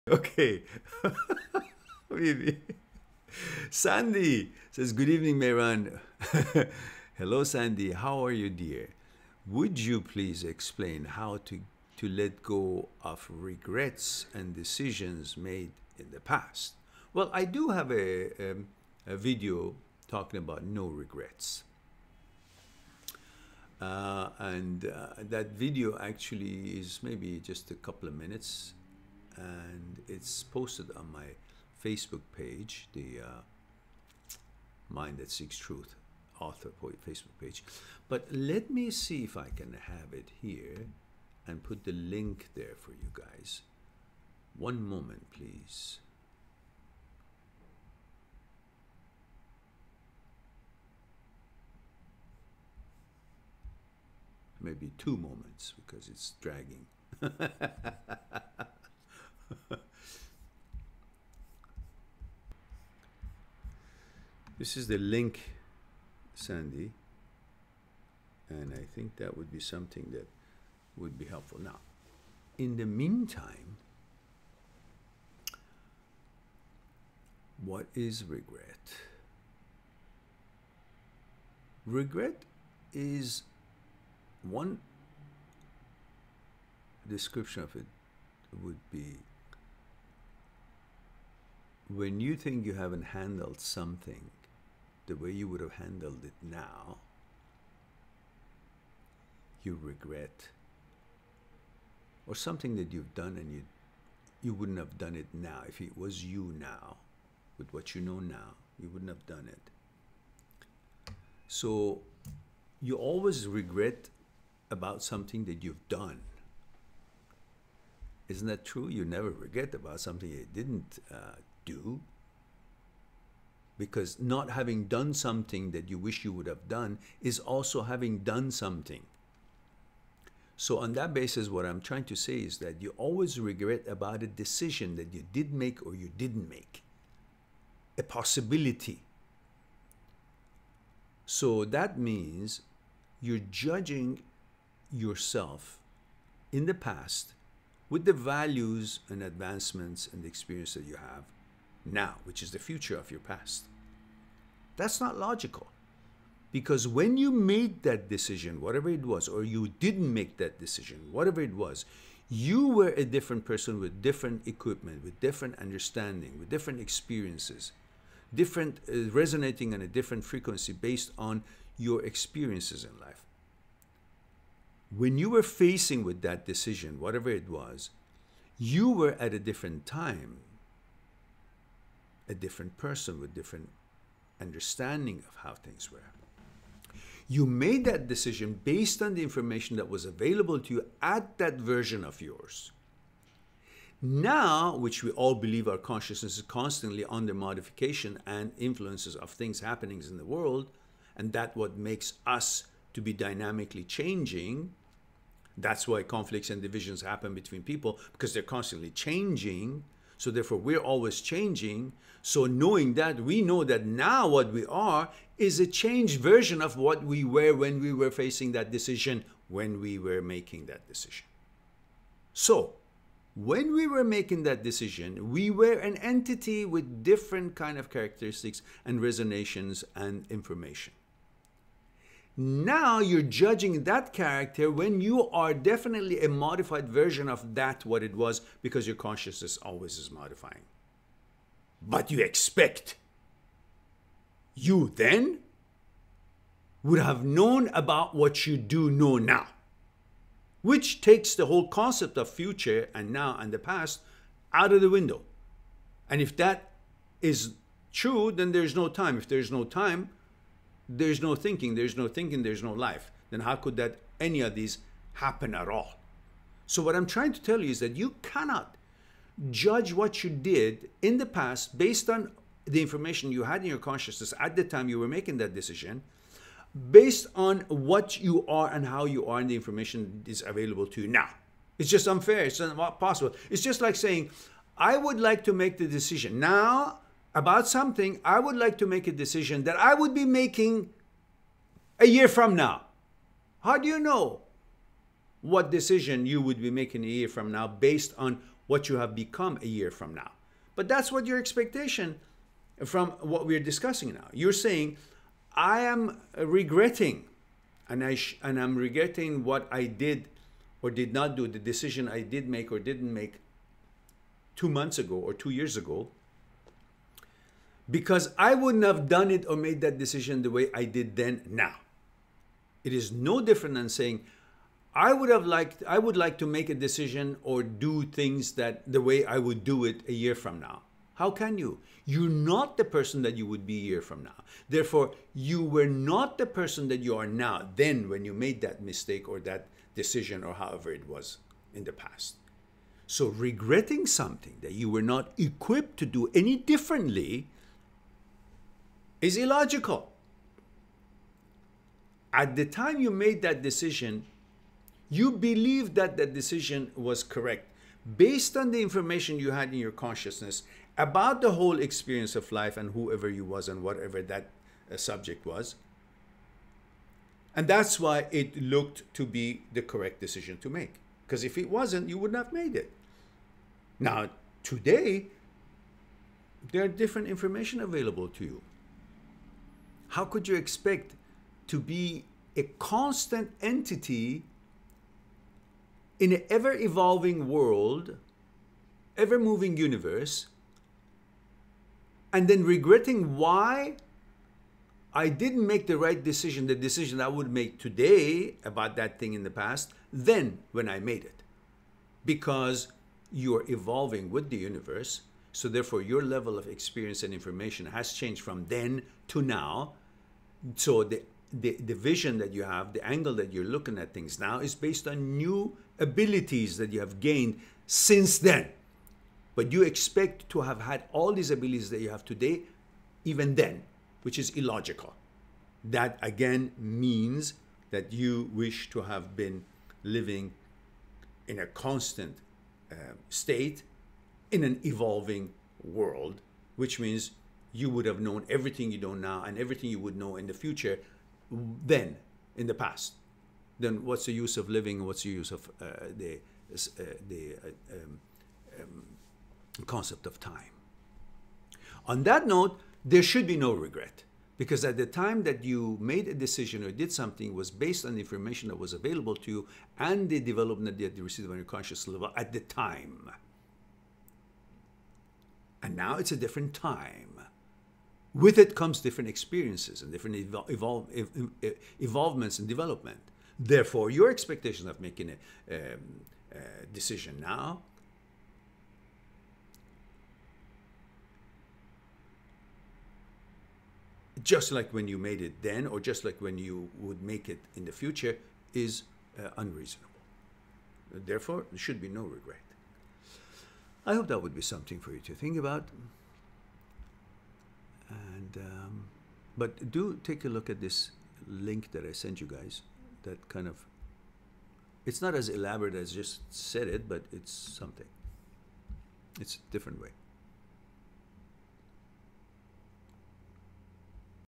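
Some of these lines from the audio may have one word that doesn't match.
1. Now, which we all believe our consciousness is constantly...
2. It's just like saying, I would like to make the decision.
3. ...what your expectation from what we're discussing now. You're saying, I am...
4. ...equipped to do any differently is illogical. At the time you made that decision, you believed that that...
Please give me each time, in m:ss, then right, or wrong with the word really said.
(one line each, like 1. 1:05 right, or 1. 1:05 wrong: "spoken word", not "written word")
1. 3:14 right
2. 4:43 right
3. 5:01 right
4. 5:45 right.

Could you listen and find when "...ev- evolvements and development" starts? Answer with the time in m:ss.
7:51.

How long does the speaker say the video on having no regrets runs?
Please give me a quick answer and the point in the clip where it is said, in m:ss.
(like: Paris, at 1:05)
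a couple of minutes, at 0:27.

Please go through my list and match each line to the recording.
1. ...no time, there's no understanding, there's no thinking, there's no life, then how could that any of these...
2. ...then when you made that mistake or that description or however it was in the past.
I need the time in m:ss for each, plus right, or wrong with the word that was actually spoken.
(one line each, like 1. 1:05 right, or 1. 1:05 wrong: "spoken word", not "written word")
1. 4:19 wrong: "thinking", not "understanding"
2. 5:37 wrong: "decision", not "description".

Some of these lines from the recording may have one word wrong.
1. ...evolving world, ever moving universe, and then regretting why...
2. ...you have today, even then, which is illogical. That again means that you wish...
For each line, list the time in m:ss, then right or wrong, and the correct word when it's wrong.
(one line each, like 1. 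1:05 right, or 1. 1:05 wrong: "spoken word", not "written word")
1. 6:26 right
2. 7:01 right.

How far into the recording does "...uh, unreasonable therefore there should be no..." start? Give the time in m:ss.
8:09.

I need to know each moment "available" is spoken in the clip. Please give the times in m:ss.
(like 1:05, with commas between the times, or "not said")
3:10, 4:40, 6:17, 7:38.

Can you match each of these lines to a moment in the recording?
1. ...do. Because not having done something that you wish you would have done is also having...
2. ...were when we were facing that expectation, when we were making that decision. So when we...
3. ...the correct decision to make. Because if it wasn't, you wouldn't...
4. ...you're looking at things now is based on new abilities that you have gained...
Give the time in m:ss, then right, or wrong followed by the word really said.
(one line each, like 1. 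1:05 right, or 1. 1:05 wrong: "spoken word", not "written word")
1. 2:01 right
2. 3:37 wrong: "decision", not "expectation"
3. 6:09 right
4. 6:53 right.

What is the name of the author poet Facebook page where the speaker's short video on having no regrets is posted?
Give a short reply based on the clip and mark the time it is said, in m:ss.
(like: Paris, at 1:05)
Mind That Seeks Truth, at 0:34.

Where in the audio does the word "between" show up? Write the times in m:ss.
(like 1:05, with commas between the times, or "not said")
3:27.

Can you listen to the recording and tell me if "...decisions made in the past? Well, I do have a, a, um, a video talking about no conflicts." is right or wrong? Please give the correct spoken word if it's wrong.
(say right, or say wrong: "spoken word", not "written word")
wrong: "regrets", not "conflicts".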